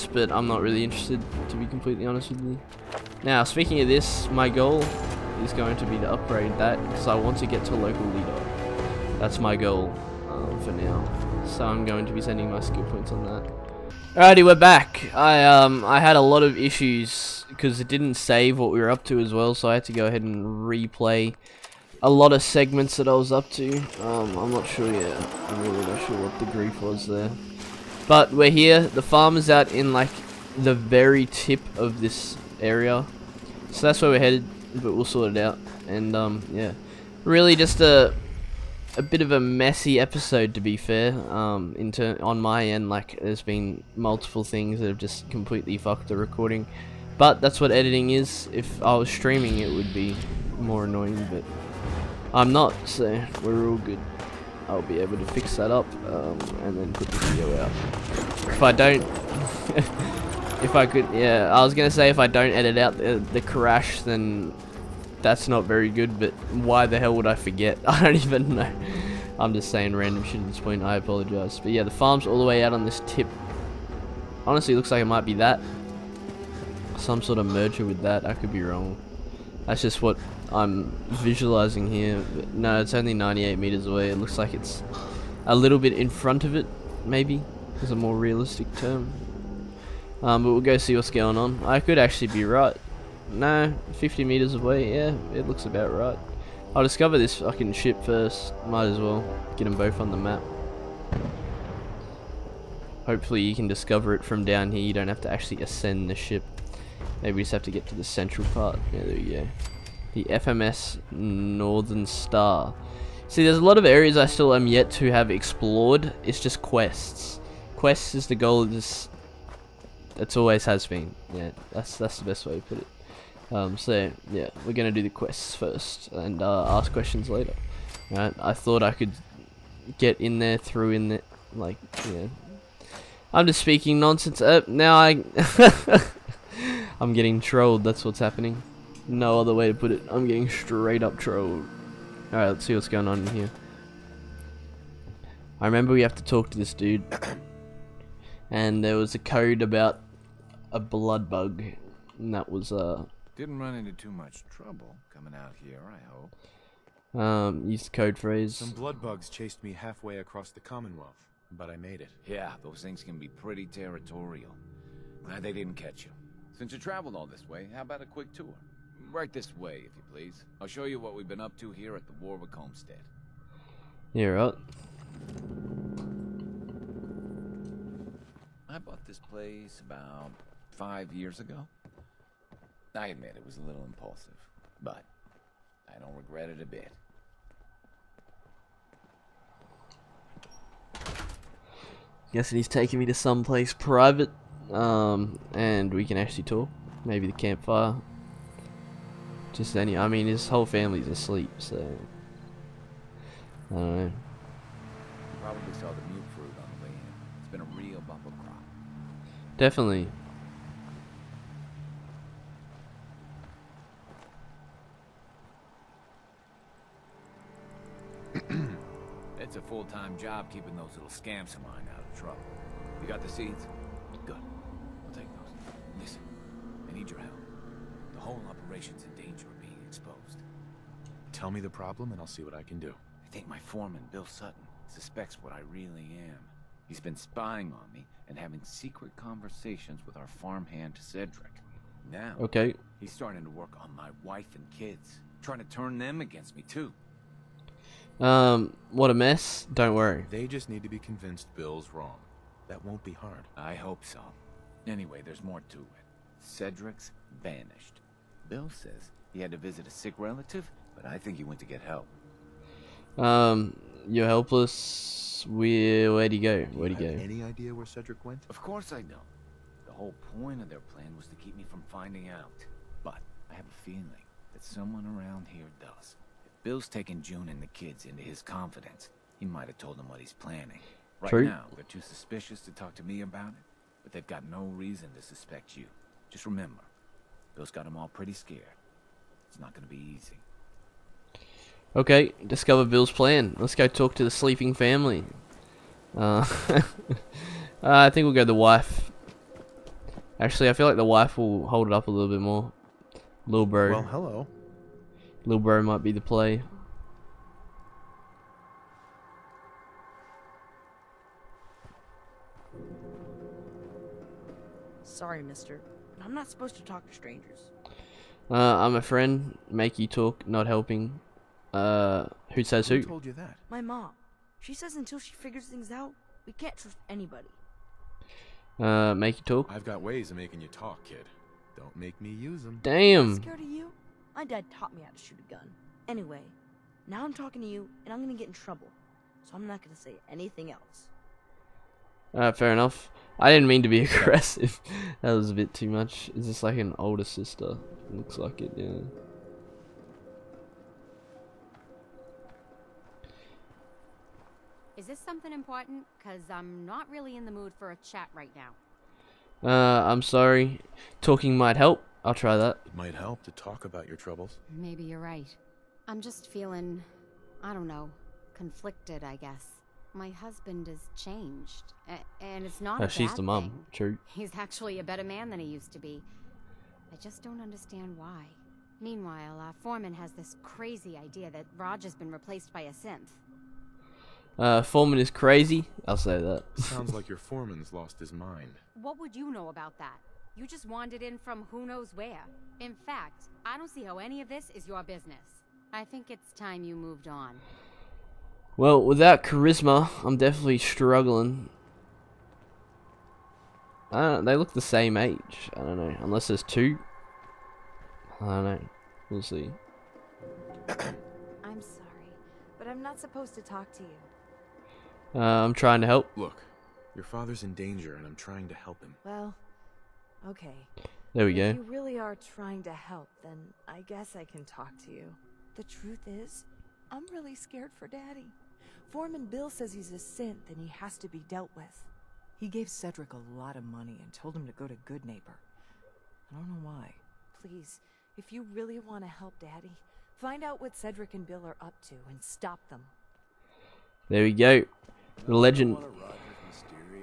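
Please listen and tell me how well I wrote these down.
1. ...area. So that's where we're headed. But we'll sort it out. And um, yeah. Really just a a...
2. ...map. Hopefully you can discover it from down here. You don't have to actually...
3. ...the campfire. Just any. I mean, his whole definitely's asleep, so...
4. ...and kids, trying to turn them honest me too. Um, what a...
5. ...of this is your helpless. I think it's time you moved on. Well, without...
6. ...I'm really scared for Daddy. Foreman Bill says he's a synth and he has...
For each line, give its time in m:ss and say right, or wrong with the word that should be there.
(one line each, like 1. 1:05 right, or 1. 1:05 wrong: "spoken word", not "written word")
1. 0:32 right
2. 1:40 right
3. 3:17 wrong: "family", not "definitely"
4. 4:04 wrong: "against", not "honest"
5. 6:34 wrong: "business", not "helpless"
6. 7:07 right.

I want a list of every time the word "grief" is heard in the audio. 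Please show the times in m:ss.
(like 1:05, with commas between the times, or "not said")
0:26.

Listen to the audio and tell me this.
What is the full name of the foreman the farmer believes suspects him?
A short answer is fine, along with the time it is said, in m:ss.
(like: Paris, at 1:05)
Bill Sutton, at 3:54.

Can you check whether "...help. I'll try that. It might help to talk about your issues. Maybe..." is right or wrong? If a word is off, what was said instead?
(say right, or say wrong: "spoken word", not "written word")
wrong: "troubles", not "issues".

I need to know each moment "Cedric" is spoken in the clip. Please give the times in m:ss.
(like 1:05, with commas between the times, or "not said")
4:00, 4:16, 4:27, 7:12, 7:20.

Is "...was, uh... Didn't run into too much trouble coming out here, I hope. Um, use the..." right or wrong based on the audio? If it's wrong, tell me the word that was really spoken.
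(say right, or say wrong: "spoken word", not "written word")
right.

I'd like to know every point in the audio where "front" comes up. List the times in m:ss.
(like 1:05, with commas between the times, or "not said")
1:26.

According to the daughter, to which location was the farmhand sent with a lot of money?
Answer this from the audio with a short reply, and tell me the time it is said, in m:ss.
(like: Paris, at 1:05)
Goodneighbor, at 7:14.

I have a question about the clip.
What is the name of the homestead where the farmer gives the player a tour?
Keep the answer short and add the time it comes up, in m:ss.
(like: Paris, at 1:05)
Warwick Homestead, at 2:52.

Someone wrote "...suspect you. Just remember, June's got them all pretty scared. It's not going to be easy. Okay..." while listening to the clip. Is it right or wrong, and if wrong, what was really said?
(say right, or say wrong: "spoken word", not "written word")
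wrong: "Bill", not "June".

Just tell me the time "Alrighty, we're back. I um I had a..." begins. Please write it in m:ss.
0:14.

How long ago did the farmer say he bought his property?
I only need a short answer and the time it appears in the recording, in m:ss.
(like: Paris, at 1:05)
5 years, at 3:00.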